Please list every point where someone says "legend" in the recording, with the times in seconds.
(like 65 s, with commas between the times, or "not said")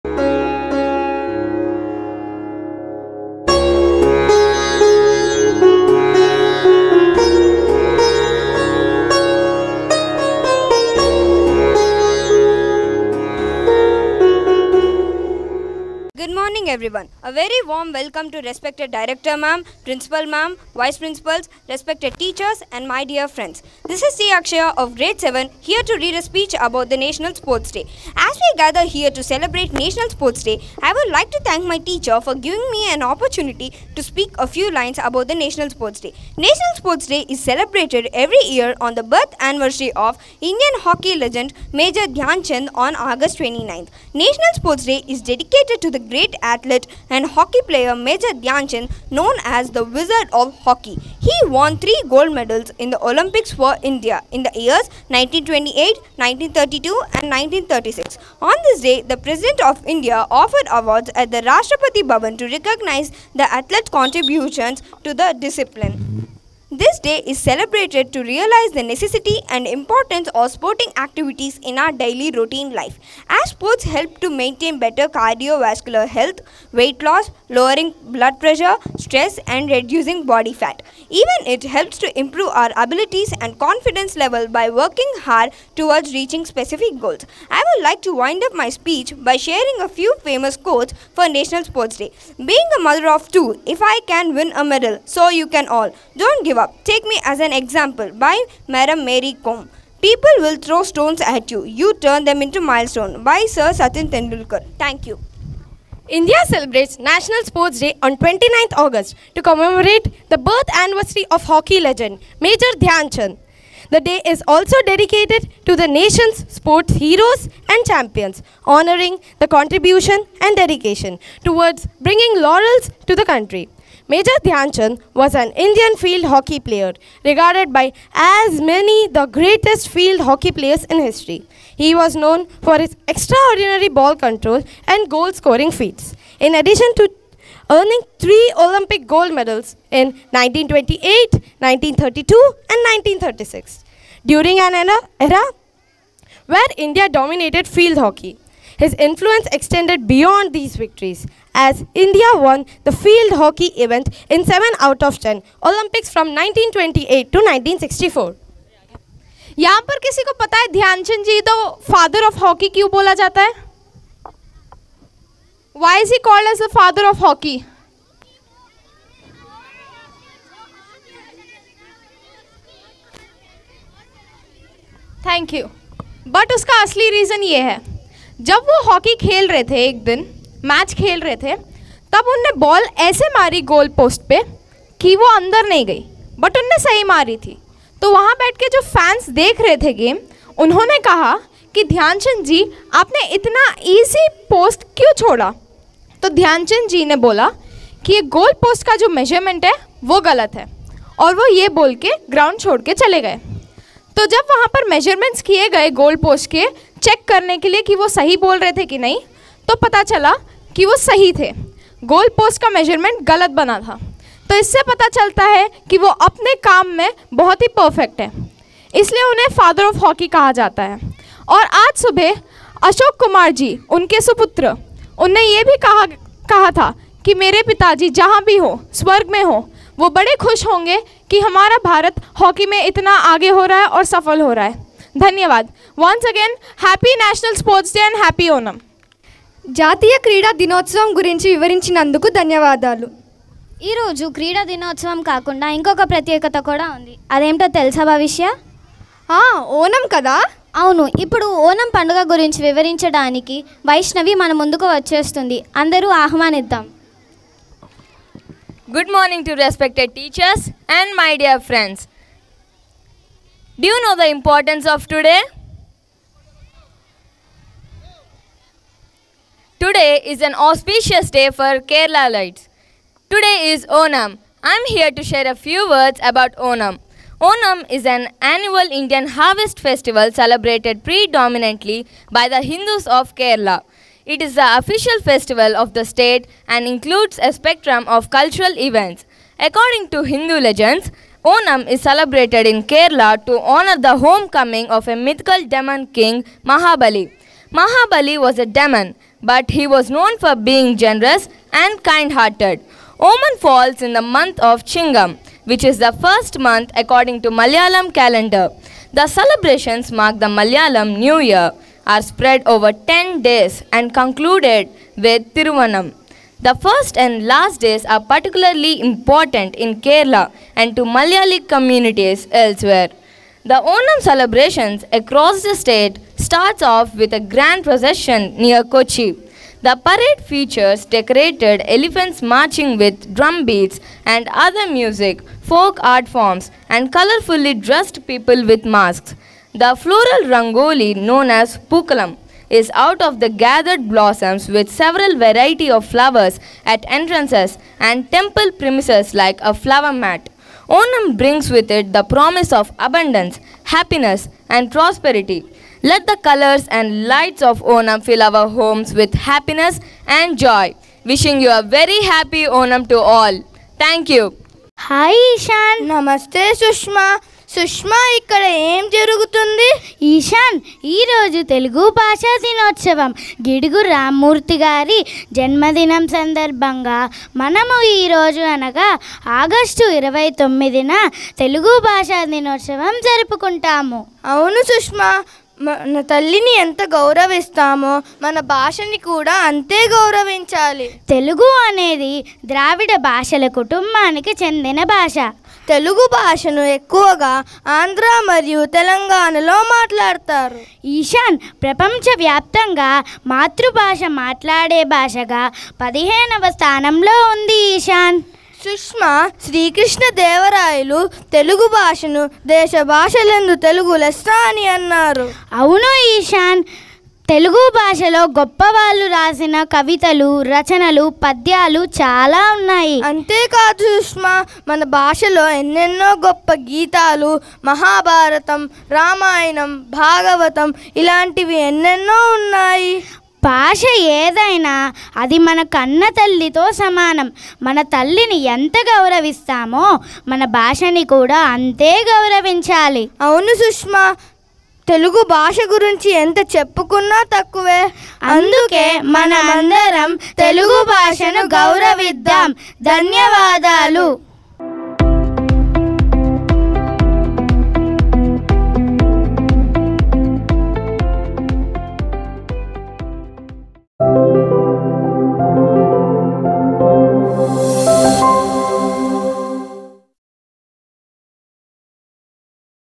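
41 s, 111 s, 290 s.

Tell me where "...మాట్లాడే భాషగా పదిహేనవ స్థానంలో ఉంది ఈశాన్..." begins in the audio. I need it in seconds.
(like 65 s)
404 s.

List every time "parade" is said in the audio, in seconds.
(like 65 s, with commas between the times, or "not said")
330 s.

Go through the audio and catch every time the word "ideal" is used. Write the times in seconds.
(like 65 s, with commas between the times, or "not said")
not said.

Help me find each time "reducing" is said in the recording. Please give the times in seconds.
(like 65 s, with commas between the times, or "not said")
79 s.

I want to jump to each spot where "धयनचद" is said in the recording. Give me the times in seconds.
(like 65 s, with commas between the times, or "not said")
160 s, 191 s, 196 s.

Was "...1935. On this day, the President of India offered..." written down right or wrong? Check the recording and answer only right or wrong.
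wrong.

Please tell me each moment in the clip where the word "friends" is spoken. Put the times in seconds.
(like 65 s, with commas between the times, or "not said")
23 s, 261 s.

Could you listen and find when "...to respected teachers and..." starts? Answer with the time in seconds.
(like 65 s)
259 s.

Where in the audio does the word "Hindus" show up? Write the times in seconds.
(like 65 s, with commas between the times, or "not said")
282 s, 290 s.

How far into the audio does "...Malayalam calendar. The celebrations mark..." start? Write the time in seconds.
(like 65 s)
307 s.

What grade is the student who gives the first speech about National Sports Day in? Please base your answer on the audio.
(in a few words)
Grade 7.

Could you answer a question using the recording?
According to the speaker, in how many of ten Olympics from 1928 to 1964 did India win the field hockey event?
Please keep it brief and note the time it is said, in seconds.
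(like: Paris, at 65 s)
7, at 154 s.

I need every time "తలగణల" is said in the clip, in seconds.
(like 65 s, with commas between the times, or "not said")
398 s.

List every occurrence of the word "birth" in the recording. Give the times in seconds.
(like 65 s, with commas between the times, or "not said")
39 s, 110 s.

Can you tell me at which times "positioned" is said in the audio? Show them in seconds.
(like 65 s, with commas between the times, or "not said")
not said.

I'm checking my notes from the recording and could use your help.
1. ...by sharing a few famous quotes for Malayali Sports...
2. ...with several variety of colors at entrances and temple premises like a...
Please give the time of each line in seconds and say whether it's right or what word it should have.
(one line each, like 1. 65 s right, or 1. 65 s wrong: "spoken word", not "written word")
1. 89 s wrong: "National", not "Malayali"
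2. 344 s wrong: "flowers", not "colors".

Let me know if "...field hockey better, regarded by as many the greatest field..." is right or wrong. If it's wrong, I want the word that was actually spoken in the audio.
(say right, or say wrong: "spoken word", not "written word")
wrong: "player", not "better".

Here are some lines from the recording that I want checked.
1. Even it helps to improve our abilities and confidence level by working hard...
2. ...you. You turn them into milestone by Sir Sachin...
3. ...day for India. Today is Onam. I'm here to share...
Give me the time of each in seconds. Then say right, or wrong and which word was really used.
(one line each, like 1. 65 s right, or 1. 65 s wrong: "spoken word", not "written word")
1. 81 s right
2. 101 s right
3. 271 s wrong: "Keralites", not "India".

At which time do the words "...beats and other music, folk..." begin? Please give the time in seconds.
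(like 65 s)
333 s.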